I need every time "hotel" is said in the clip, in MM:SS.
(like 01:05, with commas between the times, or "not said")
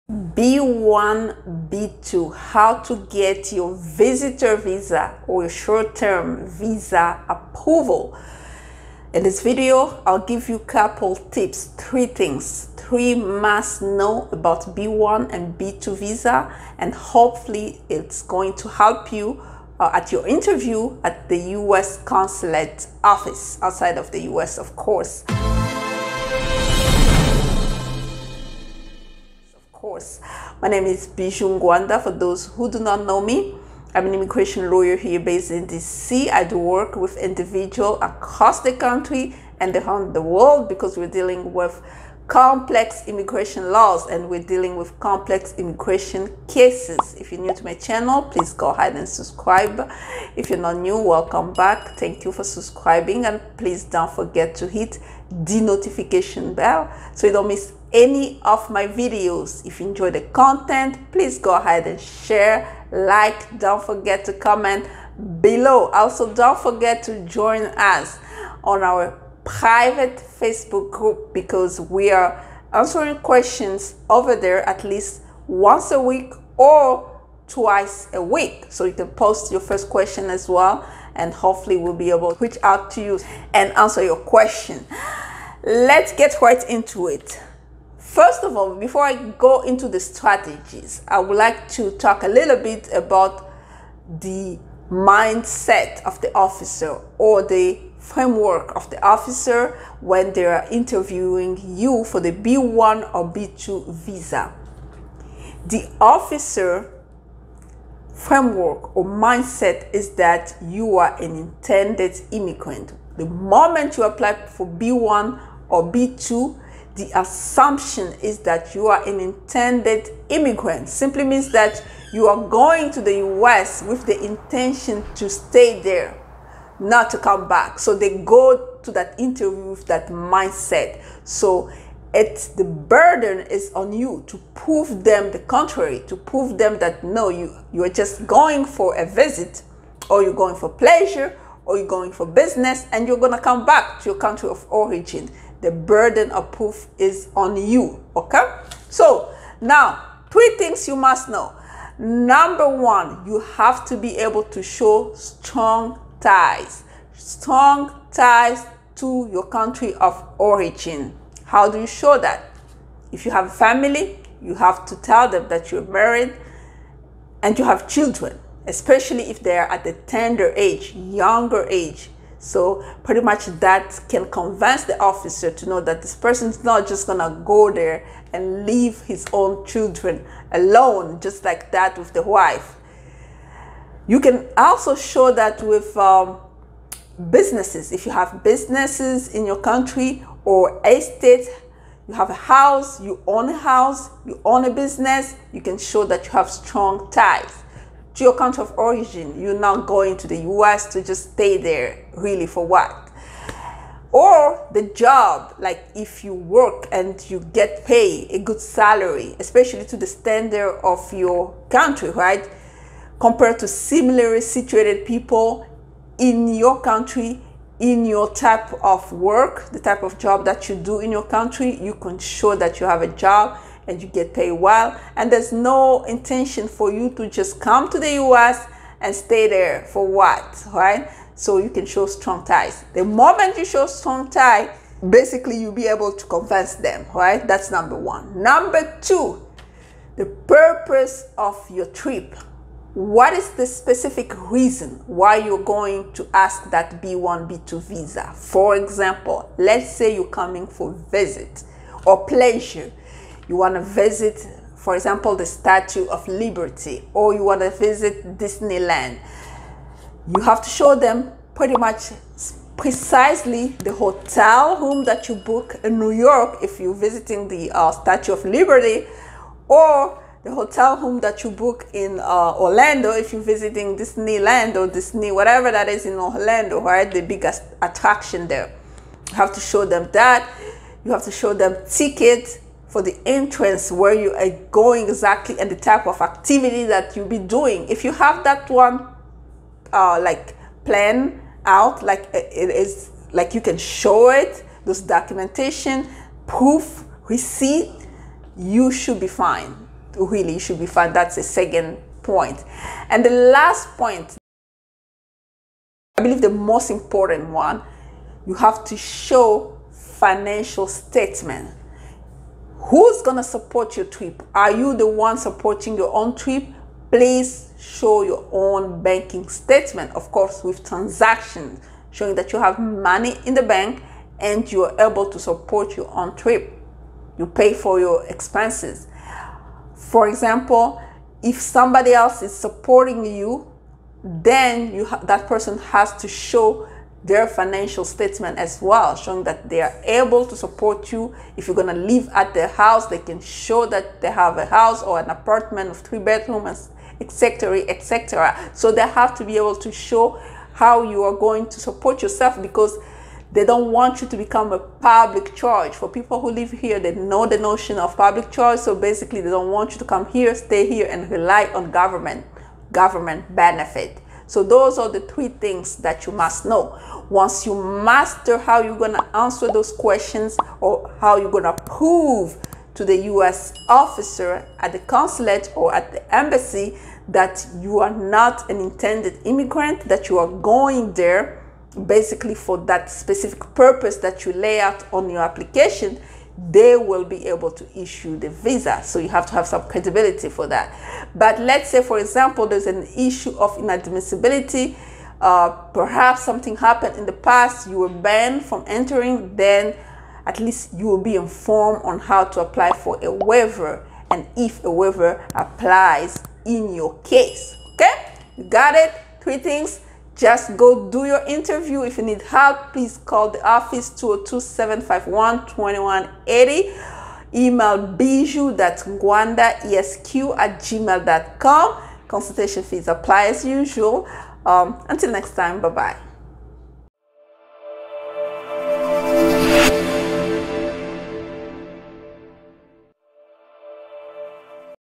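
04:23, 04:30.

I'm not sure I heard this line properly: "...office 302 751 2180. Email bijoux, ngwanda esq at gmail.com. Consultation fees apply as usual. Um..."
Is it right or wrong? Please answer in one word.
wrong.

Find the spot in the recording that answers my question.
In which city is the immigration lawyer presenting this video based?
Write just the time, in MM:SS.
00:35.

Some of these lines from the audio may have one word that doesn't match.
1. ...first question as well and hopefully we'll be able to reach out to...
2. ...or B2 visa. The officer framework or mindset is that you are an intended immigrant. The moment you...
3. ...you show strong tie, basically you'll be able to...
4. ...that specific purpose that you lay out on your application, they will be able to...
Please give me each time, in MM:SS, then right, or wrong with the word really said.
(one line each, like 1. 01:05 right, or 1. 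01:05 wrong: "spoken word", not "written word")
1. 01:19 right
2. 01:43 right
3. 03:53 right
4. 06:22 right.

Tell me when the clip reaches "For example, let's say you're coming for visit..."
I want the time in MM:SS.
04:08.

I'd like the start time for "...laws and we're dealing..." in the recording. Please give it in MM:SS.
00:43.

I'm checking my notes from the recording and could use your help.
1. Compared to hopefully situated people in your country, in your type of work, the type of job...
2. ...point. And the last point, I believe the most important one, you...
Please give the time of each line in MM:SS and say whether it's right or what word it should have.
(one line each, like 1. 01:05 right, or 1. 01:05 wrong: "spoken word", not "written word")
1. 03:33 wrong: "similarly", not "hopefully"
2. 05:02 right.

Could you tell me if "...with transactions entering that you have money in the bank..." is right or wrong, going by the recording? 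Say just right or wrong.
wrong.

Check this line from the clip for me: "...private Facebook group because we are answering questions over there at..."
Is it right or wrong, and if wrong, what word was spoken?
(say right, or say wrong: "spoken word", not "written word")
right.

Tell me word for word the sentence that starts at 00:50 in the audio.
If you're not new, welcome back.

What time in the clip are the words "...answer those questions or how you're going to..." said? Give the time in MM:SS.
06:09.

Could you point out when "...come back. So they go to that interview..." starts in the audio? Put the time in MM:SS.
02:07.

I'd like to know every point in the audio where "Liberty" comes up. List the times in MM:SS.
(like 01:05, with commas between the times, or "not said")
04:16, 04:28.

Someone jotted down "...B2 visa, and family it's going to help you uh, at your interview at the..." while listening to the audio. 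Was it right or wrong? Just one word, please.
wrong.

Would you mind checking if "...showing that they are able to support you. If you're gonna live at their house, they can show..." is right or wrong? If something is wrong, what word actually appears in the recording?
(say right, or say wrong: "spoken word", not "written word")
right.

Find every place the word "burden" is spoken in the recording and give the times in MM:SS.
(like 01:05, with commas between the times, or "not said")
02:12, 02:25.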